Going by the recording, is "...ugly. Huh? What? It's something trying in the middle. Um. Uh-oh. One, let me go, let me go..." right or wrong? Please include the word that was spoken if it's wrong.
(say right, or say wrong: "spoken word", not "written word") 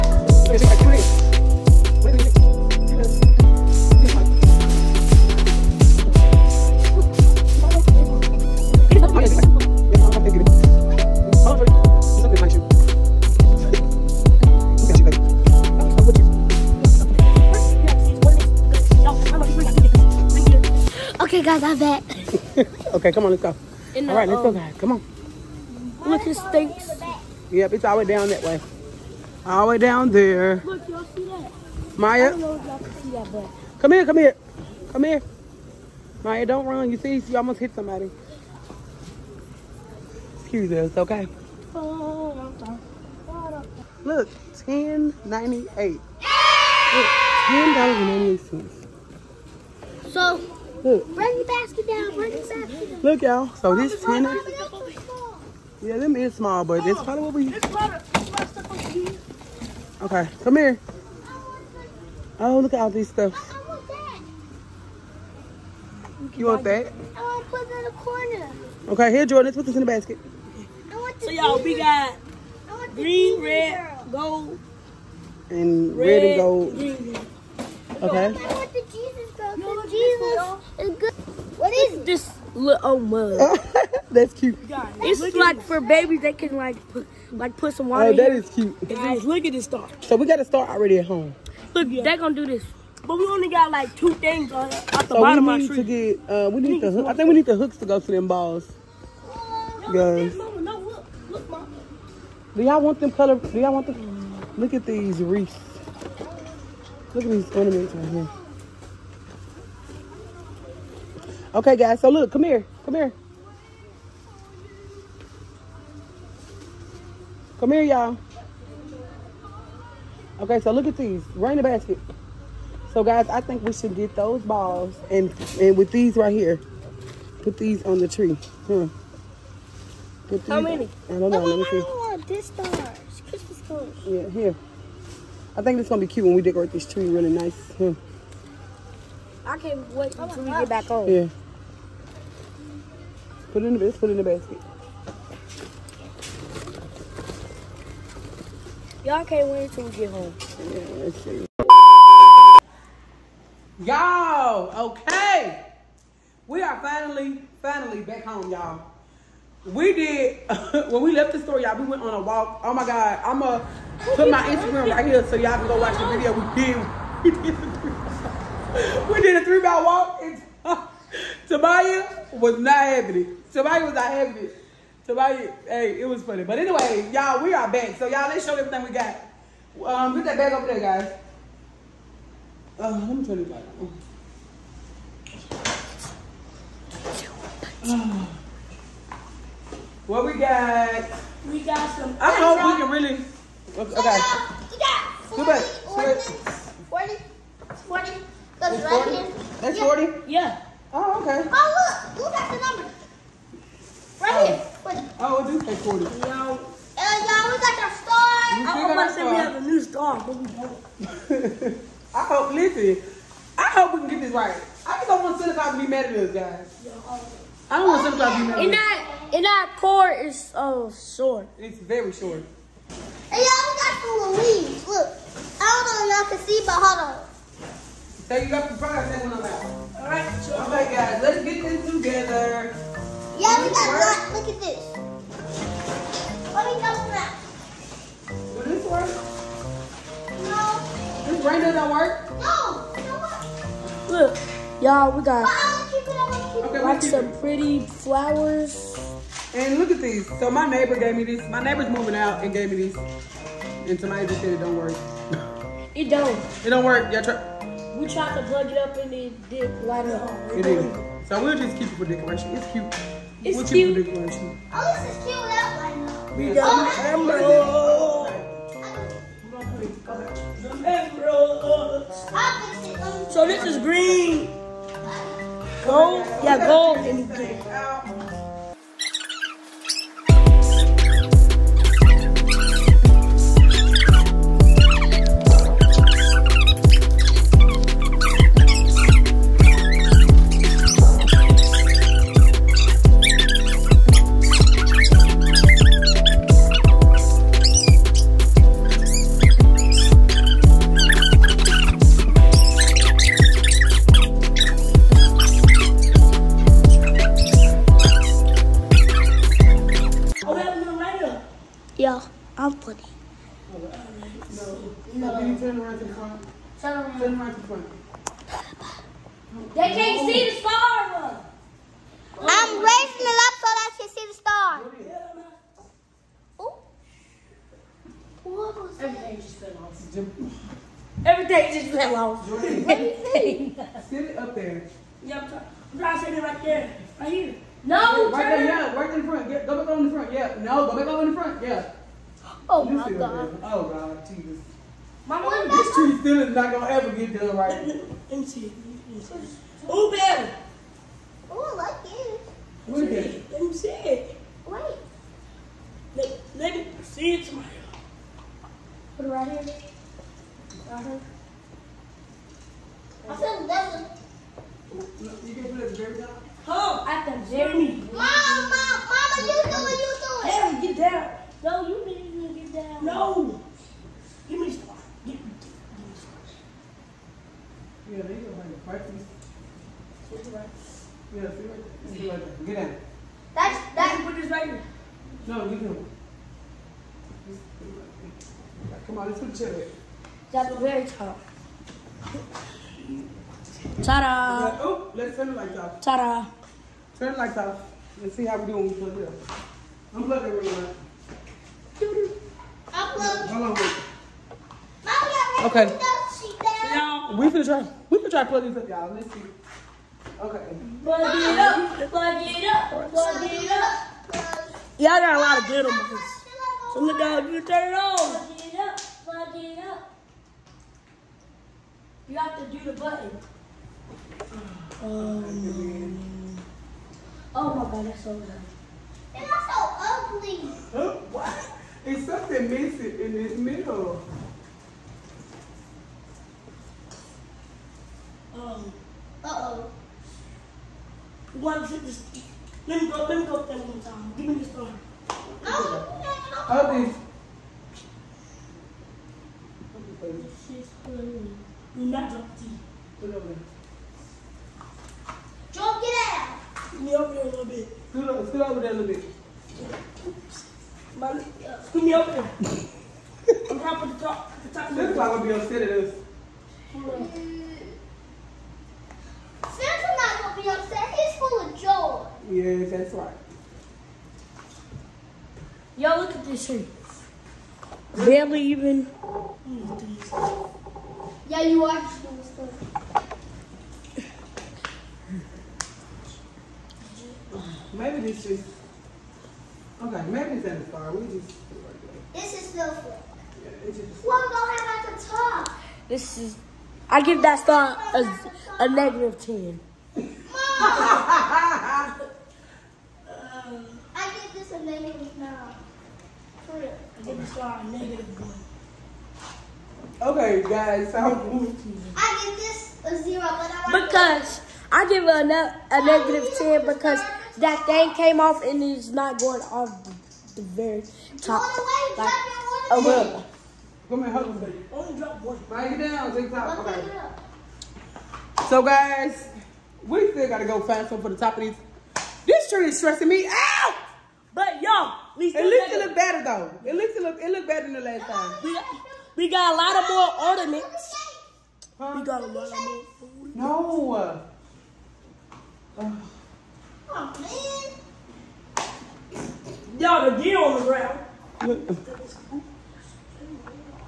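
wrong: "missing", not "trying".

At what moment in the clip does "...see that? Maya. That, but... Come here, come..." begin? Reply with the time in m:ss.
0:31.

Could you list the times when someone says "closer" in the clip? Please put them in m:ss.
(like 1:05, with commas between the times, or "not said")
not said.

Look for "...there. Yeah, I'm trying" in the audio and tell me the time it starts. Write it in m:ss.
5:34.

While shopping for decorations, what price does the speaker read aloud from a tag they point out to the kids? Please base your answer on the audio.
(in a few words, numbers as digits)
$10.98.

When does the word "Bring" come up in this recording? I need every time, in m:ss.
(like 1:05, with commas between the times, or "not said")
8:45.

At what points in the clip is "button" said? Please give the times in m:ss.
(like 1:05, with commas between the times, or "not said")
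7:02.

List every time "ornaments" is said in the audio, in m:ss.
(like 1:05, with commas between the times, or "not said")
1:47, 9:00.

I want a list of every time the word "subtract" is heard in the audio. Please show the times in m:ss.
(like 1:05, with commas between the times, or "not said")
not said.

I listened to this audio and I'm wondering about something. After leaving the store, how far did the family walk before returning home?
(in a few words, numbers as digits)
3 miles.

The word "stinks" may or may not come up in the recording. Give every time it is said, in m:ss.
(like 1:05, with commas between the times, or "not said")
0:26.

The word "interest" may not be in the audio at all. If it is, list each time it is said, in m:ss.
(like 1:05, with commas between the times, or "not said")
not said.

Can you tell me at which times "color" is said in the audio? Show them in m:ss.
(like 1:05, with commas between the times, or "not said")
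1:43, 2:13.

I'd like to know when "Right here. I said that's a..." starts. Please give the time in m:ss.
6:00.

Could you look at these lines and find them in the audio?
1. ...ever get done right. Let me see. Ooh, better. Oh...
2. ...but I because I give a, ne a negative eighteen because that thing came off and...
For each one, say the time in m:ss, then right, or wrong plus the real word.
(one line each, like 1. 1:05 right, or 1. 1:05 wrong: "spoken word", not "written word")
1. 5:46 right
2. 8:33 wrong: "ten", not "eighteen".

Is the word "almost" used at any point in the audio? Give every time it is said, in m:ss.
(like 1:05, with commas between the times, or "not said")
0:37, 3:28.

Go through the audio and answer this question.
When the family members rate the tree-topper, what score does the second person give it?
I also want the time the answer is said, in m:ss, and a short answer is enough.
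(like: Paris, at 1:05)
-9, at 8:24.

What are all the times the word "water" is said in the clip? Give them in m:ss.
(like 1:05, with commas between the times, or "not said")
1:27.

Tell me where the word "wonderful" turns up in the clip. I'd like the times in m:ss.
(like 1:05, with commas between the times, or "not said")
not said.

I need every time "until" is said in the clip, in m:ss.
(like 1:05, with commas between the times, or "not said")
2:20, 2:29.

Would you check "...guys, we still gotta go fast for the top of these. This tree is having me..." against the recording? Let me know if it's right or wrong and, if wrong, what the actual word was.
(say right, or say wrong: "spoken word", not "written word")
wrong: "stressing", not "having".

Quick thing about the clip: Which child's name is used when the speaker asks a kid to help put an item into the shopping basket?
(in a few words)
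Jordan.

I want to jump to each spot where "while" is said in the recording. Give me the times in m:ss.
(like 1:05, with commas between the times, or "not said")
not said.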